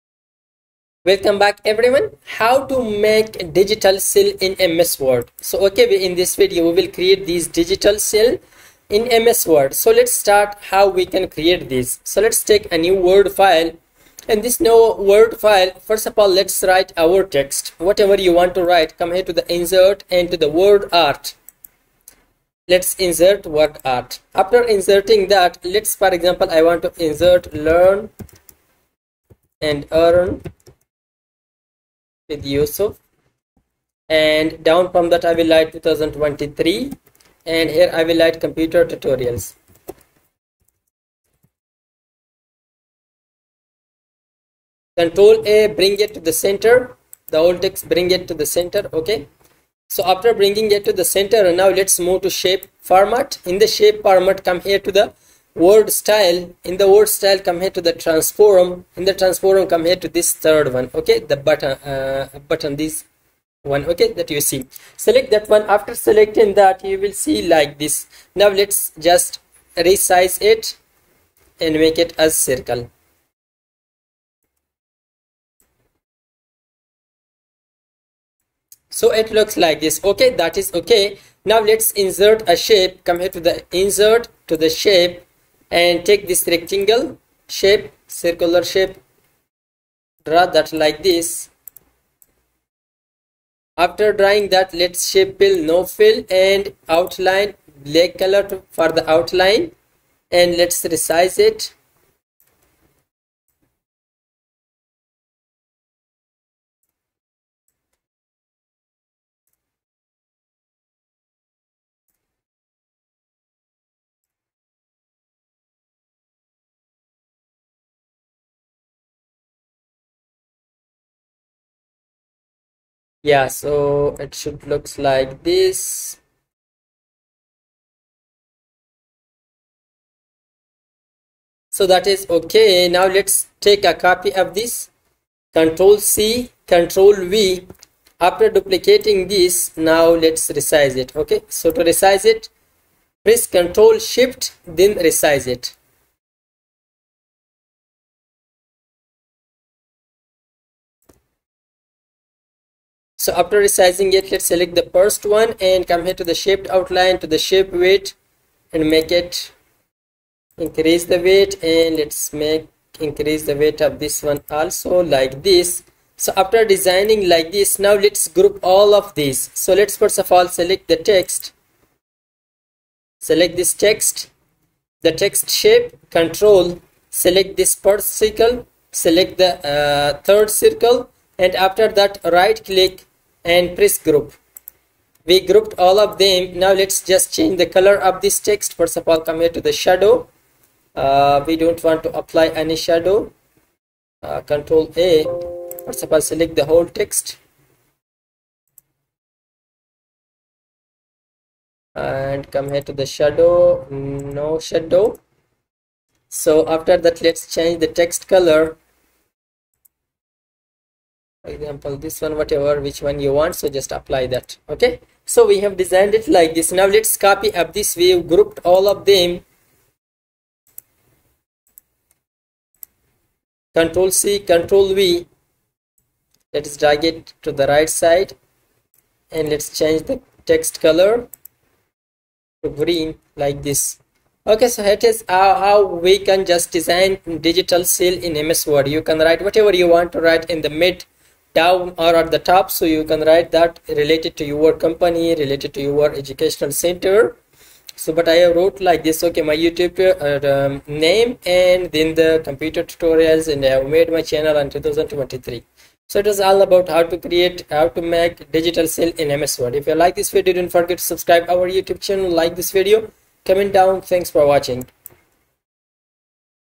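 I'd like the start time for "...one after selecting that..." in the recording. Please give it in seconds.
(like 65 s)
65 s.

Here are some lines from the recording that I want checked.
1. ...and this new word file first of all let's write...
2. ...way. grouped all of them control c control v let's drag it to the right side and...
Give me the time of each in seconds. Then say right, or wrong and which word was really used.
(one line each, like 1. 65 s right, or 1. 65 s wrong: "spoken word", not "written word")
1. 14 s right
2. 217 s right.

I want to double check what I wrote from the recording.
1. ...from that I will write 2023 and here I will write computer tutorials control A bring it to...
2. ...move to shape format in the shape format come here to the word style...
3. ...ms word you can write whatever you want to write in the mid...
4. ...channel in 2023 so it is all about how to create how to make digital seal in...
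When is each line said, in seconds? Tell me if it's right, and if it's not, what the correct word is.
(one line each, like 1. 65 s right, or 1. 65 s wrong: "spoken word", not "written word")
1. 34 s right
2. 52 s right
3. 238 s right
4. 254 s right.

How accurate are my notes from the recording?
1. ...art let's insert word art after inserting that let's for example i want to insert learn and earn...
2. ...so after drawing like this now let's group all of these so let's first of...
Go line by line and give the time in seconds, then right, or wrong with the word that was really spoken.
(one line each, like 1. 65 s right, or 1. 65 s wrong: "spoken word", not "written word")
1. 20 s right
2. 166 s wrong: "designing", not "drawing".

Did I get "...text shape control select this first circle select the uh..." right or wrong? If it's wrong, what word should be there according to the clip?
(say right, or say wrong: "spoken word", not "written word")
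right.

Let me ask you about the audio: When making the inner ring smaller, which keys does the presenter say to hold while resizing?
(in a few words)
Control Shift.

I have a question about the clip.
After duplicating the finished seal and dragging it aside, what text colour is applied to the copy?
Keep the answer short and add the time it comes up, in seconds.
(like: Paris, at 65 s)
Green, at 232 s.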